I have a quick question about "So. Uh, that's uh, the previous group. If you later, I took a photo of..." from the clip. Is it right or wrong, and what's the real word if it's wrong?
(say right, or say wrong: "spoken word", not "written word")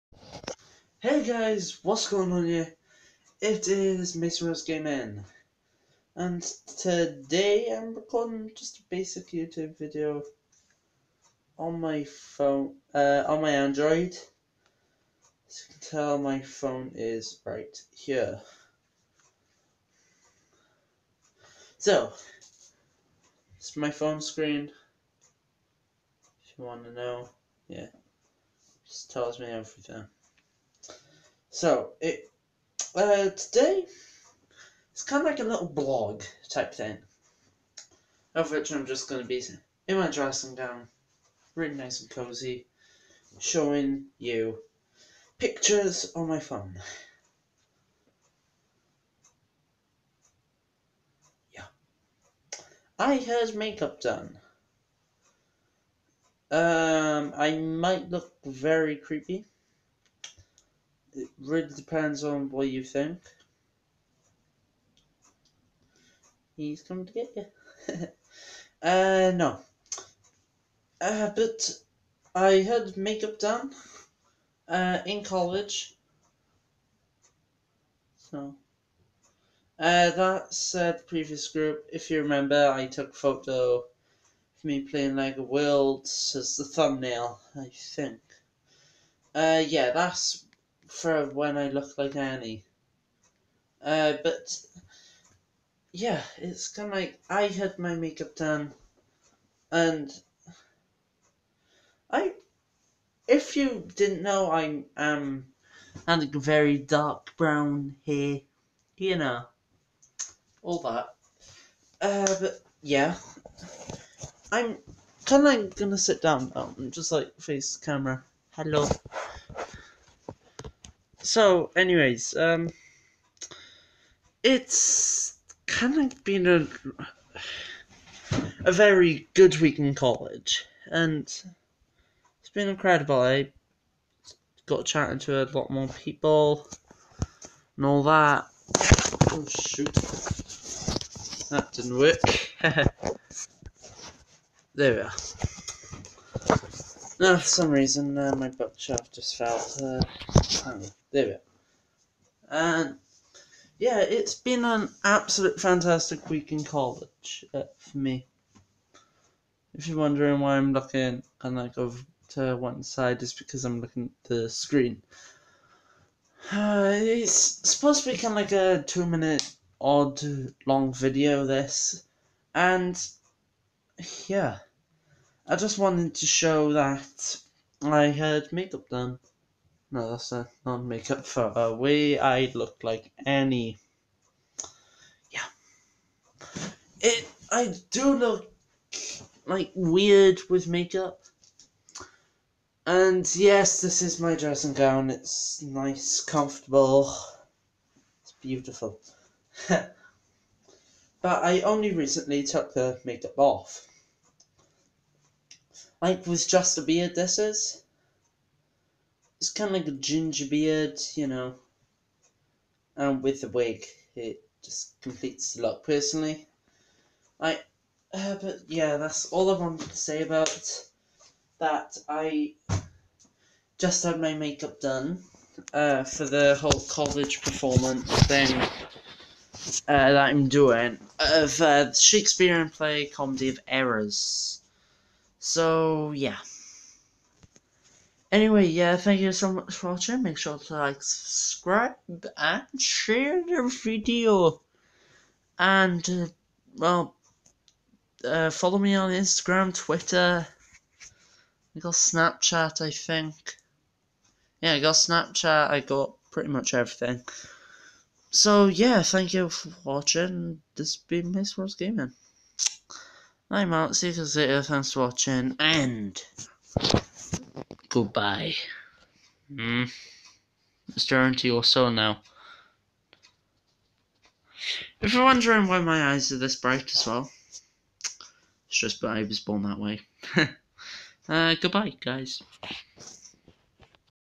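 wrong: "remember", not "later".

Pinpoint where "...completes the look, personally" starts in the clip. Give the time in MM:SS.
03:35.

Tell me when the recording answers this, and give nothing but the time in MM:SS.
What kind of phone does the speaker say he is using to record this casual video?
00:13.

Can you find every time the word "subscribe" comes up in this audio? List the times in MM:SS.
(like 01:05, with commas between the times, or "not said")
04:01.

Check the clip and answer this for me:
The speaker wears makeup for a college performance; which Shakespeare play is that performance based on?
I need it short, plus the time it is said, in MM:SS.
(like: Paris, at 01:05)
Comedy of Errors, at 03:53.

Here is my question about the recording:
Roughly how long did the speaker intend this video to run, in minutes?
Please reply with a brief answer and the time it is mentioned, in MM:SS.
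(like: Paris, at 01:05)
2 minutes, at 02:48.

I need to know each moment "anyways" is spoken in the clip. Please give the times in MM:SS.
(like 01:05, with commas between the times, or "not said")
02:01, 03:58.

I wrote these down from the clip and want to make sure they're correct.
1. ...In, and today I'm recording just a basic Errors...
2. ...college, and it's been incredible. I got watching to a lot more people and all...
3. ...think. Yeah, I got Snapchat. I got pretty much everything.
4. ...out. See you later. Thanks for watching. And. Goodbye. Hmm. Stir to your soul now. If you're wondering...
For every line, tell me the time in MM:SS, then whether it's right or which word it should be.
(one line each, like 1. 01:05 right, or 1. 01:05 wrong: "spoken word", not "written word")
1. 00:04 wrong: "YouTube", not "Errors"
2. 02:09 wrong: "chatting", not "watching"
3. 04:12 right
4. 04:23 right.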